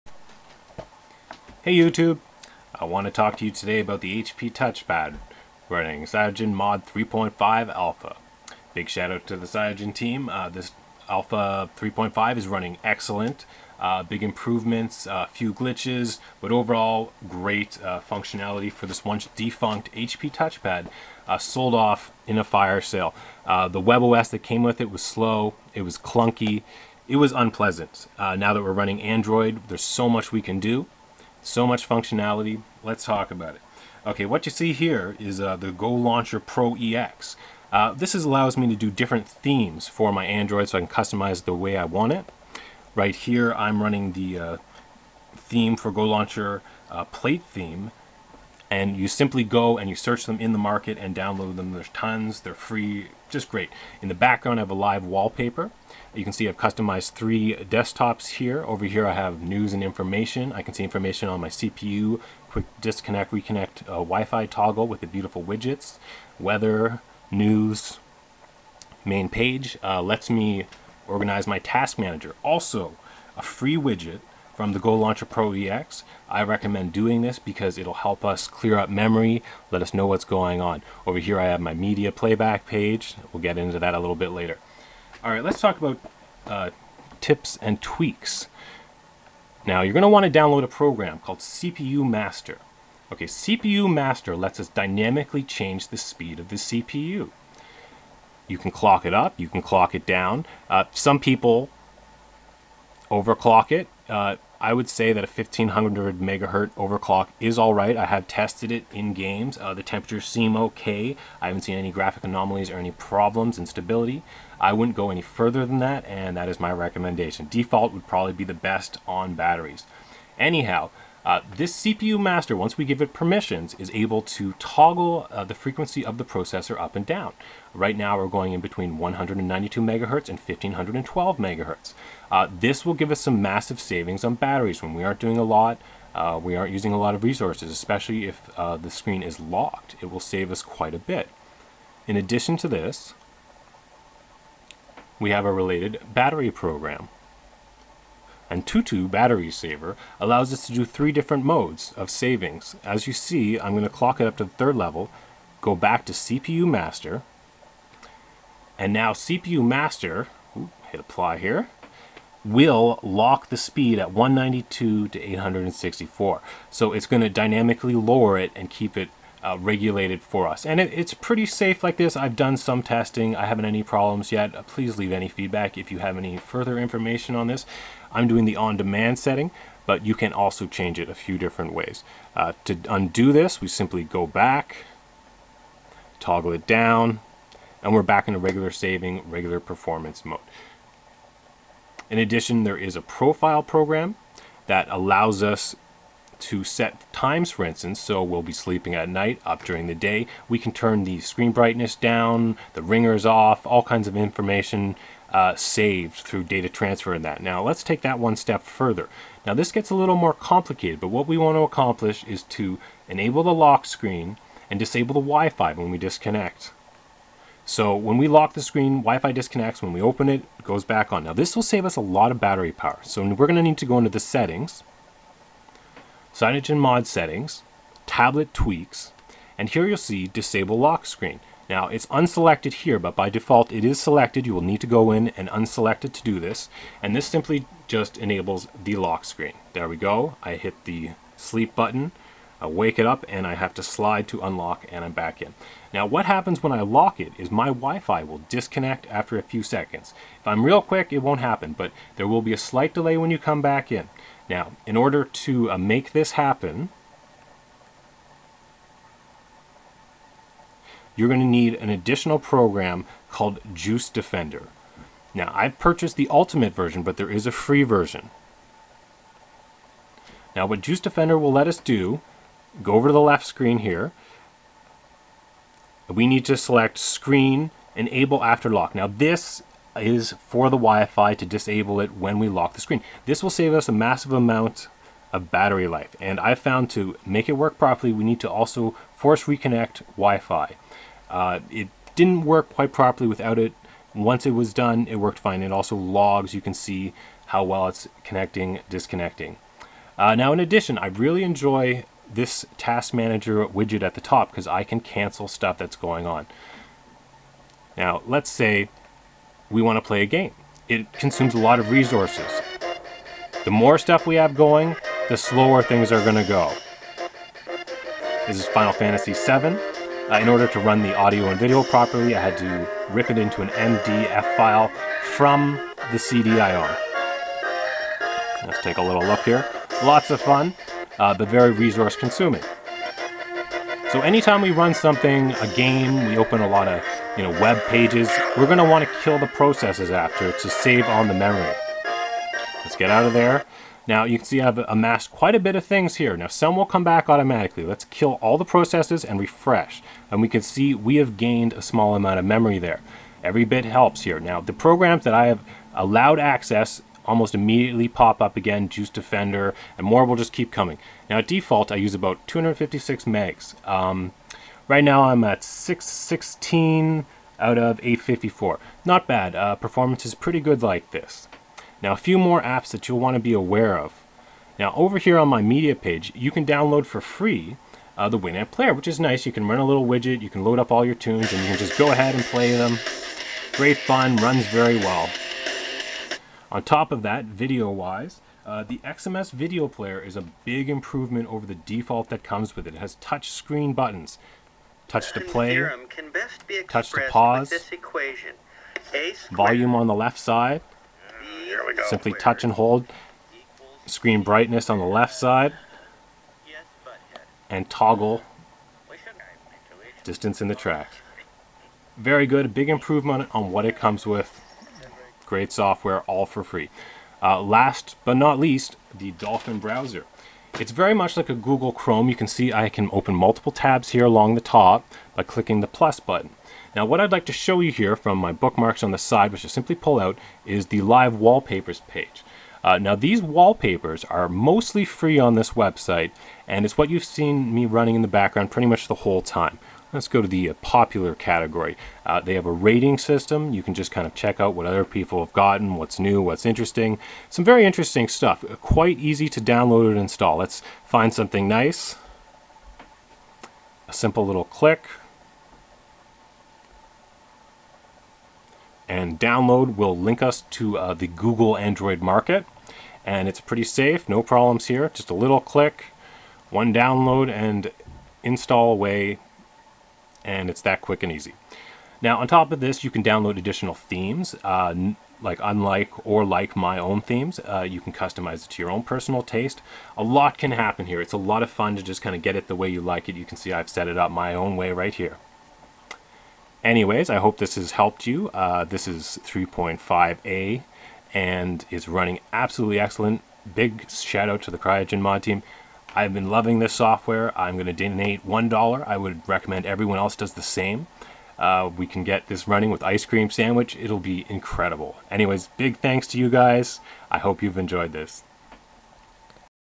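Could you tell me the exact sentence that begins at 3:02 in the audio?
Uh, to undo this, we simply go back, toggle it down, and we're back in a regular saving, regular performance mode.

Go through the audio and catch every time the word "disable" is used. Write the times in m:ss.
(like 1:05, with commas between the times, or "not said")
3:34, 3:50, 4:41.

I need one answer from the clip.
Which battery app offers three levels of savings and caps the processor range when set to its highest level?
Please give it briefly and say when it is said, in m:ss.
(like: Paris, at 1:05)
Tutu Battery Saver, at 2:28.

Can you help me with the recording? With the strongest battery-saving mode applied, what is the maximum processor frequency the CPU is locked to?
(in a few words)
864 megahertz.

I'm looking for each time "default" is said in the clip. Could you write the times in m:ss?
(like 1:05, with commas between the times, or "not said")
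1:57, 3:53, 6:01, 6:31.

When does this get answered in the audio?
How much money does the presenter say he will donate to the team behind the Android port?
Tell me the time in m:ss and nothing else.
8:18.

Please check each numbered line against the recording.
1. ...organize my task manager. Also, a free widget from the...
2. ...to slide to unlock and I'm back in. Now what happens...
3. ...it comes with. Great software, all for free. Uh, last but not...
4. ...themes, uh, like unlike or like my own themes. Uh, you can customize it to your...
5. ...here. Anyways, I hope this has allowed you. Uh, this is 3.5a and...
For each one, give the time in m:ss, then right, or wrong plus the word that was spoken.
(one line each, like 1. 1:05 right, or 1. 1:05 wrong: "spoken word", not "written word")
1. 1:11 right
2. 4:03 right
3. 6:53 right
4. 7:53 right
5. 8:05 wrong: "helped", not "allowed".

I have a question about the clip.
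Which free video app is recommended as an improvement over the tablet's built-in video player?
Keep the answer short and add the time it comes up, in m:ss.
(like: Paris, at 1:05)
MX Video Player, at 6:28.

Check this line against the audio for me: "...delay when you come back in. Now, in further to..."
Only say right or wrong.
wrong.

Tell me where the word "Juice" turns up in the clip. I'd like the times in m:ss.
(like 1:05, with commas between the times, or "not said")
4:23, 4:30, 5:58.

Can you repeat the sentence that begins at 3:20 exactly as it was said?
We can turn the screen brightness down, the ringers off, all kinds of information uh, saved through data transfer and that.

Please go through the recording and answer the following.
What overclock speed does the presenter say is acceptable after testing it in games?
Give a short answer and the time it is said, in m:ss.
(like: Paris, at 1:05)
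1500 megahertz, at 1:45.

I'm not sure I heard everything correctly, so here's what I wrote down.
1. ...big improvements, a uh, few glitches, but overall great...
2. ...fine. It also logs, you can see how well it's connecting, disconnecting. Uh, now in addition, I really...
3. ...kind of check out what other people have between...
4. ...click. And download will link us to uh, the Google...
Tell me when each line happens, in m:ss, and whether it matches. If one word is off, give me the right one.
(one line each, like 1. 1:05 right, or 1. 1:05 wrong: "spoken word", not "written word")
1. 0:14 right
2. 4:55 right
3. 7:24 wrong: "gotten", not "between"
4. 7:34 right.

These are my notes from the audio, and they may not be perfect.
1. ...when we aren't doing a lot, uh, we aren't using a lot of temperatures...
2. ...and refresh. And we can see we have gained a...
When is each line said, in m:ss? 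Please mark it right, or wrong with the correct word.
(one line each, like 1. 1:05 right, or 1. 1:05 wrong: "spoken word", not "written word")
1. 2:14 wrong: "resources", not "temperatures"
2. 5:49 right.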